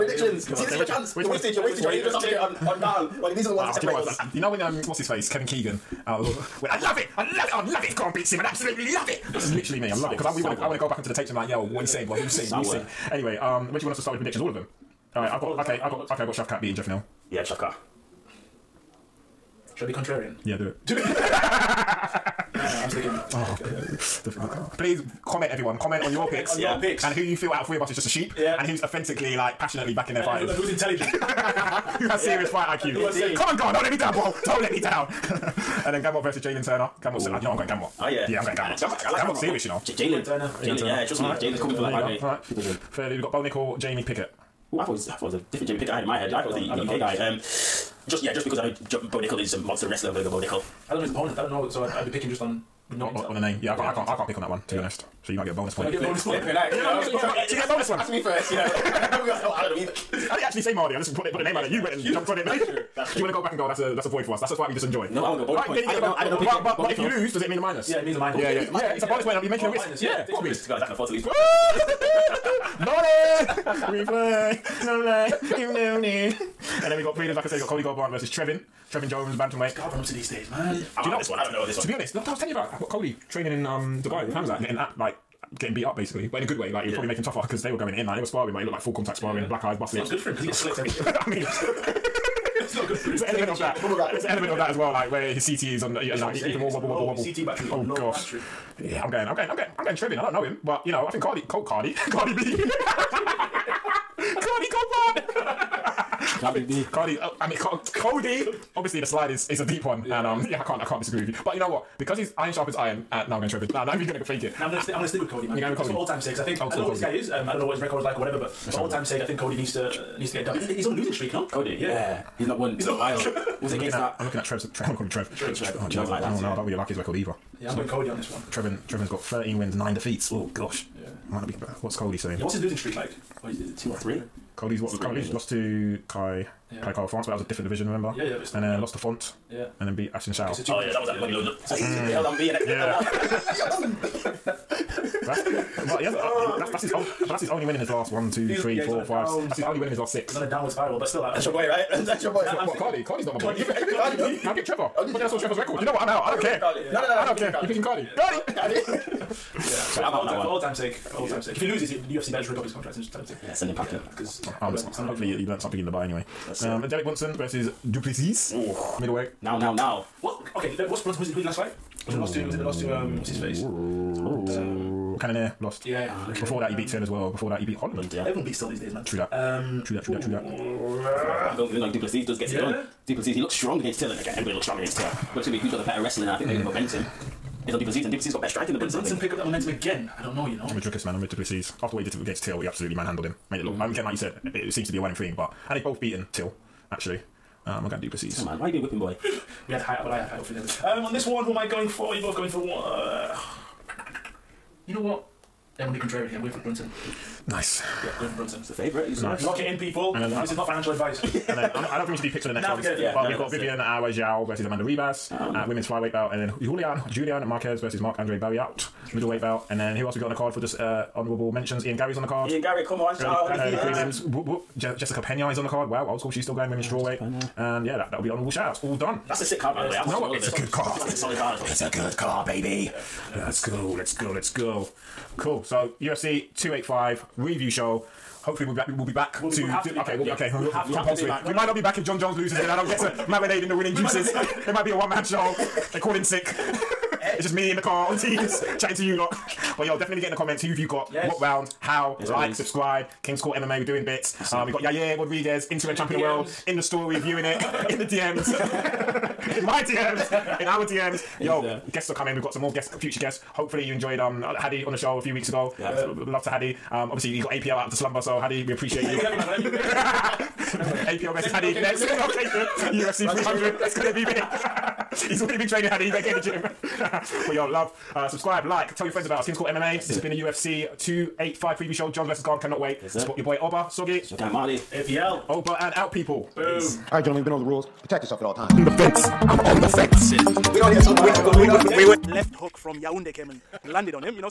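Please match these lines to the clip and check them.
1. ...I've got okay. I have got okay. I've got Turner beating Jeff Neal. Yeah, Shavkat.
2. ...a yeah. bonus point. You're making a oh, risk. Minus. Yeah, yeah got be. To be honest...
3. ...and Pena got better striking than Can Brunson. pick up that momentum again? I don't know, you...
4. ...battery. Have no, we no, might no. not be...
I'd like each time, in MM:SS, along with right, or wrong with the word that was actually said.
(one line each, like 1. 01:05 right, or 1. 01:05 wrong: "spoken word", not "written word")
1. 00:15 wrong: "Shavkat", not "Turner"
2. 01:09 right
3. 03:08 wrong: "Duplessis", not "Pena"
4. 04:00 wrong: "compulsory", not "battery".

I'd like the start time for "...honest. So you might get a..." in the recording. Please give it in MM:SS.
00:54.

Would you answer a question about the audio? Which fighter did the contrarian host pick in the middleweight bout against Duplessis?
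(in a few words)
Derek Brunson.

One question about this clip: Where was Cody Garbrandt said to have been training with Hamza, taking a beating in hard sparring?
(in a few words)
Dubai.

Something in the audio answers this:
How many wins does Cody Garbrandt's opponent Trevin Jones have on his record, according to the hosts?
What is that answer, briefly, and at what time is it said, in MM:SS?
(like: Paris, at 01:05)
13, at 02:09.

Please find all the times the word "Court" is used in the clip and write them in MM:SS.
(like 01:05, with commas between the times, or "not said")
04:13, 04:39.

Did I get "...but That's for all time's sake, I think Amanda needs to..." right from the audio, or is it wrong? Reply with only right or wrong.
wrong.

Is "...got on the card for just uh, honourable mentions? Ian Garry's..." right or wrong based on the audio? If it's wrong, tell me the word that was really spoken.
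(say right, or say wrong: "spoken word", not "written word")
right.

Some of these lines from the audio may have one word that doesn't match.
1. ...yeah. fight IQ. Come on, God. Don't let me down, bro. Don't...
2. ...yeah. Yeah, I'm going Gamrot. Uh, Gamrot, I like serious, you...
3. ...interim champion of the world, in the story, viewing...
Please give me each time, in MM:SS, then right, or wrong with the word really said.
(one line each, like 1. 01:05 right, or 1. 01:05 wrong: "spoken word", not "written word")
1. 00:32 right
2. 00:38 right
3. 04:15 right.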